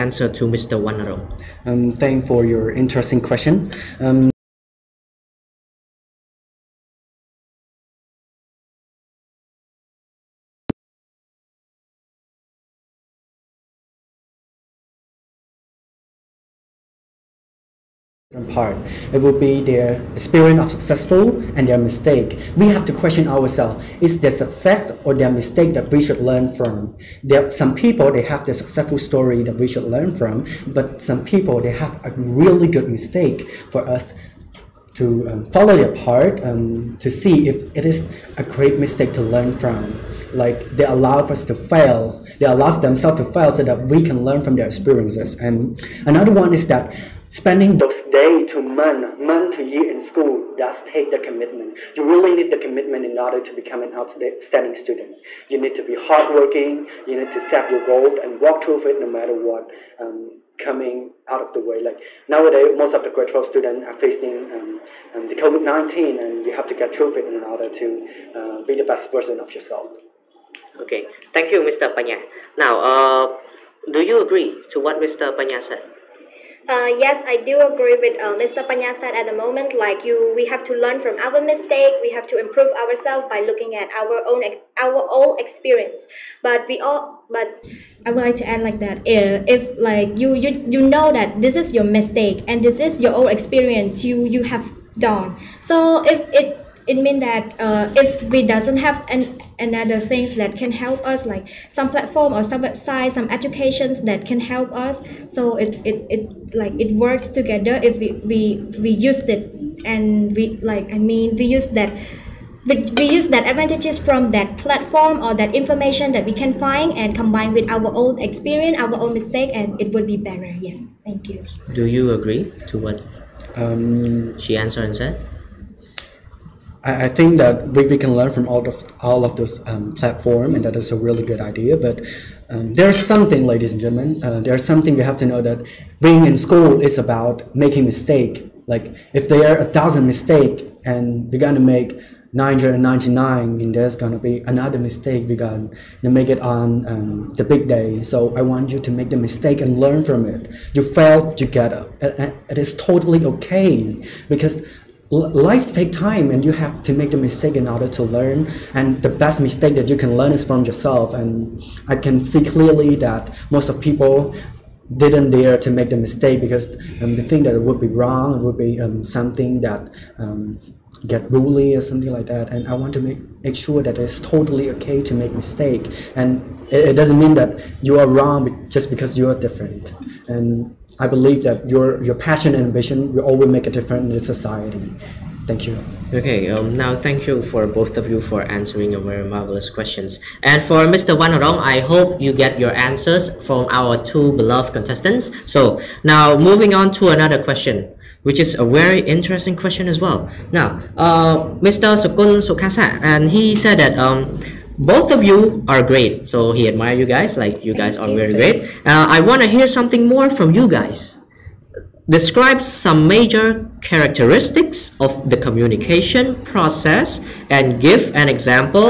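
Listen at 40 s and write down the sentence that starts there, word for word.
Like they allow us to fail, they allow themselves to fail so that we can learn from their experiences.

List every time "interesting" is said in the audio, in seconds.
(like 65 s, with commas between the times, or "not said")
2 s, 199 s.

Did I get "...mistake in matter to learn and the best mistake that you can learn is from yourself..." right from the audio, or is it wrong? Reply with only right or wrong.
wrong.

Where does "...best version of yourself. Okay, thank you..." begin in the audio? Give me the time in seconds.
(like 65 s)
68 s.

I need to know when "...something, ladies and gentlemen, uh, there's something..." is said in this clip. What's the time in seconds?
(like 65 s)
133 s.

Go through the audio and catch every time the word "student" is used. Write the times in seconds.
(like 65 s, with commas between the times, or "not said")
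54 s, 63 s.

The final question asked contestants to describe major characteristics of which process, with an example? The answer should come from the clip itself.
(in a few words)
Communication process.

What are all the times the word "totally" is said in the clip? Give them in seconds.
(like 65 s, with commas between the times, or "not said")
152 s, 174 s.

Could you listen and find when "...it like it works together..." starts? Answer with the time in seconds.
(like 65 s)
106 s.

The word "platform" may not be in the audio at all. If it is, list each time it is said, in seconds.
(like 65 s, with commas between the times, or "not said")
101 s, 114 s, 129 s.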